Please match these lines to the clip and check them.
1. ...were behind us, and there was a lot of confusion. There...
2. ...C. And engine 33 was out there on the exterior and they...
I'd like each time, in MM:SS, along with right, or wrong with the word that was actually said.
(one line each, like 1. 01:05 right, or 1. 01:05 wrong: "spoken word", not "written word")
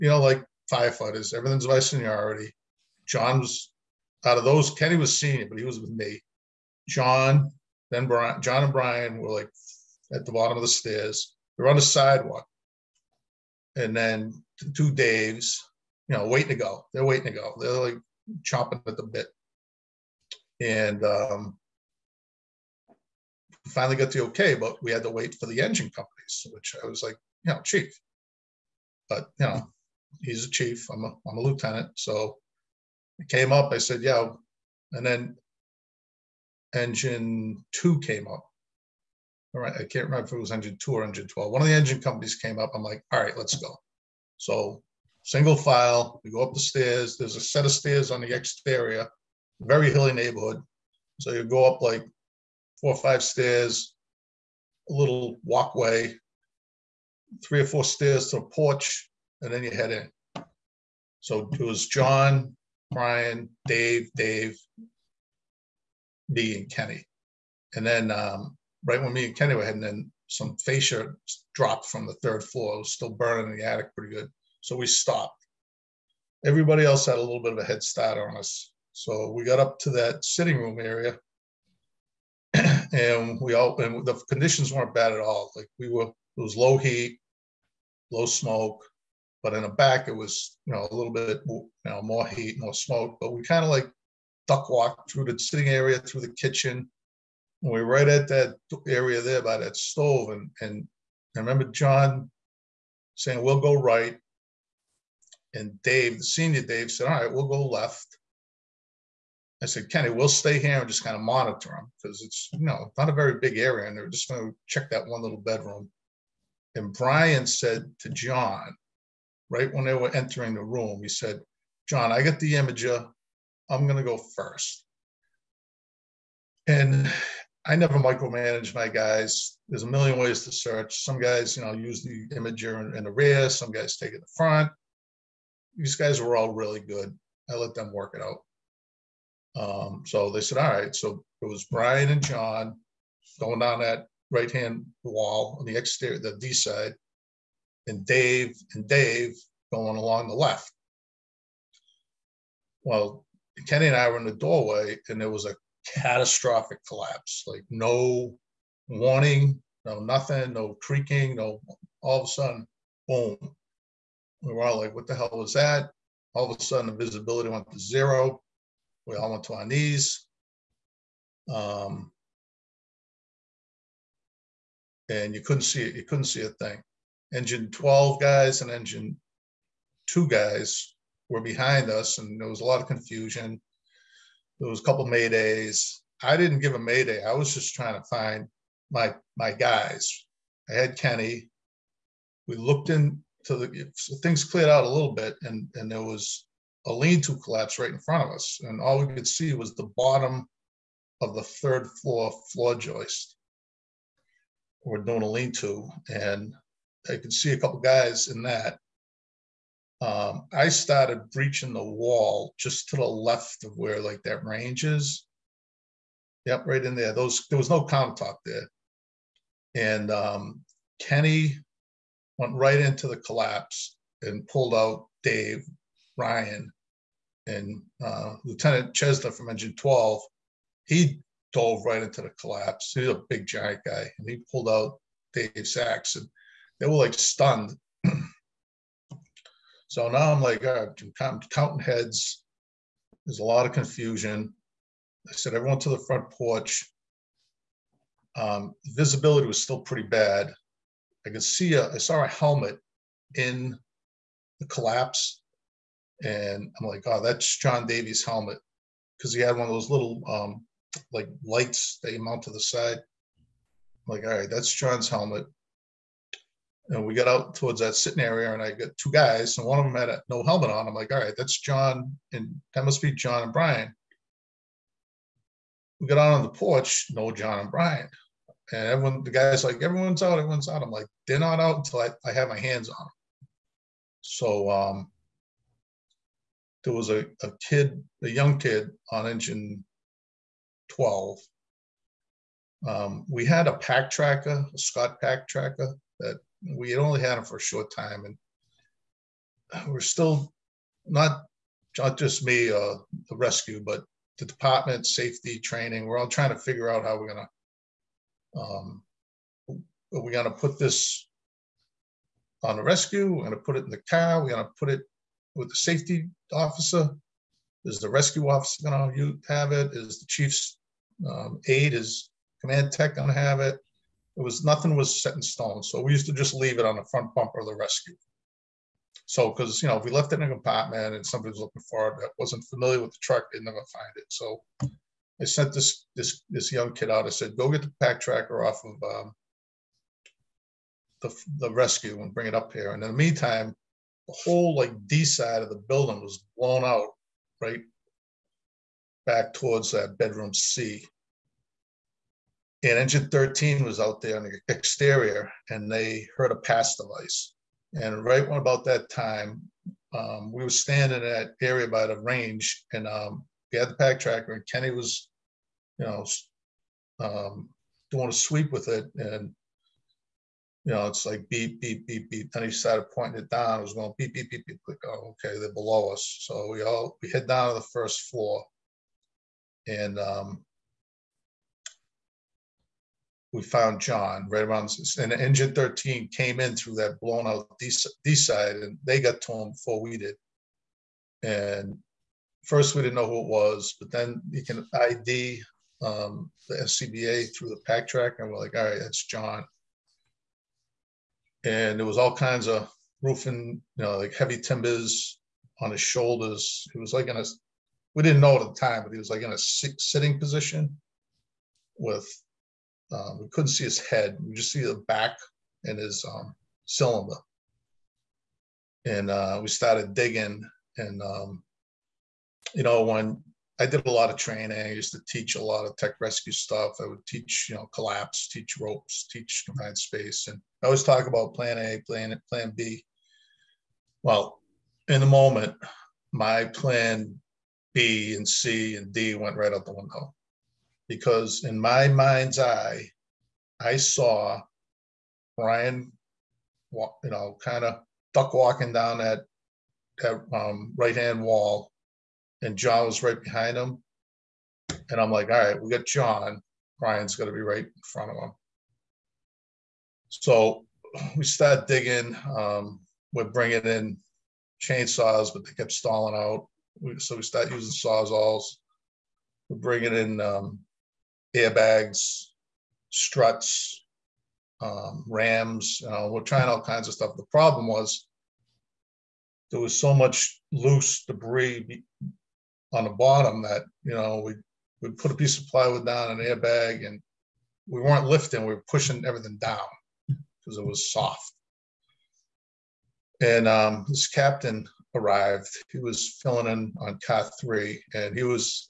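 1. 03:01 right
2. 05:50 wrong: "13", not "33".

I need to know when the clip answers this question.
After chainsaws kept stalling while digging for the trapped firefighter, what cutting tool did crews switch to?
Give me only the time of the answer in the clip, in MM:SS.
07:47.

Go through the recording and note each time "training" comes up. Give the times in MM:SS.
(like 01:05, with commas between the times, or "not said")
05:05, 07:04.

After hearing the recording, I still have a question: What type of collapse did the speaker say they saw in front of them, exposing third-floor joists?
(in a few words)
Lean-to collapse.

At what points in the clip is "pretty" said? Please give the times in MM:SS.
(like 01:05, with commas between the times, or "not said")
01:13, 04:09.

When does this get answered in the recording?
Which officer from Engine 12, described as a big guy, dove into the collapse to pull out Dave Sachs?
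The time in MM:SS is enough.
03:48.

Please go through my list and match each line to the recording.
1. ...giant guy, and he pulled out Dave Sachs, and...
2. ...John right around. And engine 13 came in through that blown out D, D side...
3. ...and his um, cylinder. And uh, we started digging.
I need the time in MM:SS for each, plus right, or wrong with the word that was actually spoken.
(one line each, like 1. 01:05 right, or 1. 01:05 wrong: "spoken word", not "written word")
1. 03:53 right
2. 06:23 right
3. 06:55 right.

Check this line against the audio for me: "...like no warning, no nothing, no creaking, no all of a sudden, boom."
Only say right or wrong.
right.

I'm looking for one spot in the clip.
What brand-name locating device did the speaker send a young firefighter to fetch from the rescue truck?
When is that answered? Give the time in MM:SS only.
04:54.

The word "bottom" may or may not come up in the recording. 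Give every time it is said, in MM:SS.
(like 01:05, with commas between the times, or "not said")
00:10, 03:19, 08:03.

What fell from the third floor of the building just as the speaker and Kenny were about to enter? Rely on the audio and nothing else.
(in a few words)
Fascia.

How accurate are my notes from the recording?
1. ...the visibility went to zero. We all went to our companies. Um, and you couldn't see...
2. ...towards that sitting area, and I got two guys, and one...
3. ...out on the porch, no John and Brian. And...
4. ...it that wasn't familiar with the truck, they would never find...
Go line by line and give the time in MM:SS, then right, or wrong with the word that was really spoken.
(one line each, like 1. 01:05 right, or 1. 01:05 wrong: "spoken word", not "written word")
1. 02:46 wrong: "knees", not "companies"
2. 04:27 right
3. 04:36 right
4. 05:32 right.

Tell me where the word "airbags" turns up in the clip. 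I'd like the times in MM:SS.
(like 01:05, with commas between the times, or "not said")
07:51, 08:06.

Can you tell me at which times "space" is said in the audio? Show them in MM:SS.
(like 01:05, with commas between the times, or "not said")
07:09.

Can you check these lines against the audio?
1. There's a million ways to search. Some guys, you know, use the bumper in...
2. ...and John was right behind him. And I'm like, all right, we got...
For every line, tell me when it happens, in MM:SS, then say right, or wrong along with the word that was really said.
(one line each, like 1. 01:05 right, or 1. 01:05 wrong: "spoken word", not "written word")
1. 02:09 wrong: "imager", not "bumper"
2. 07:32 right.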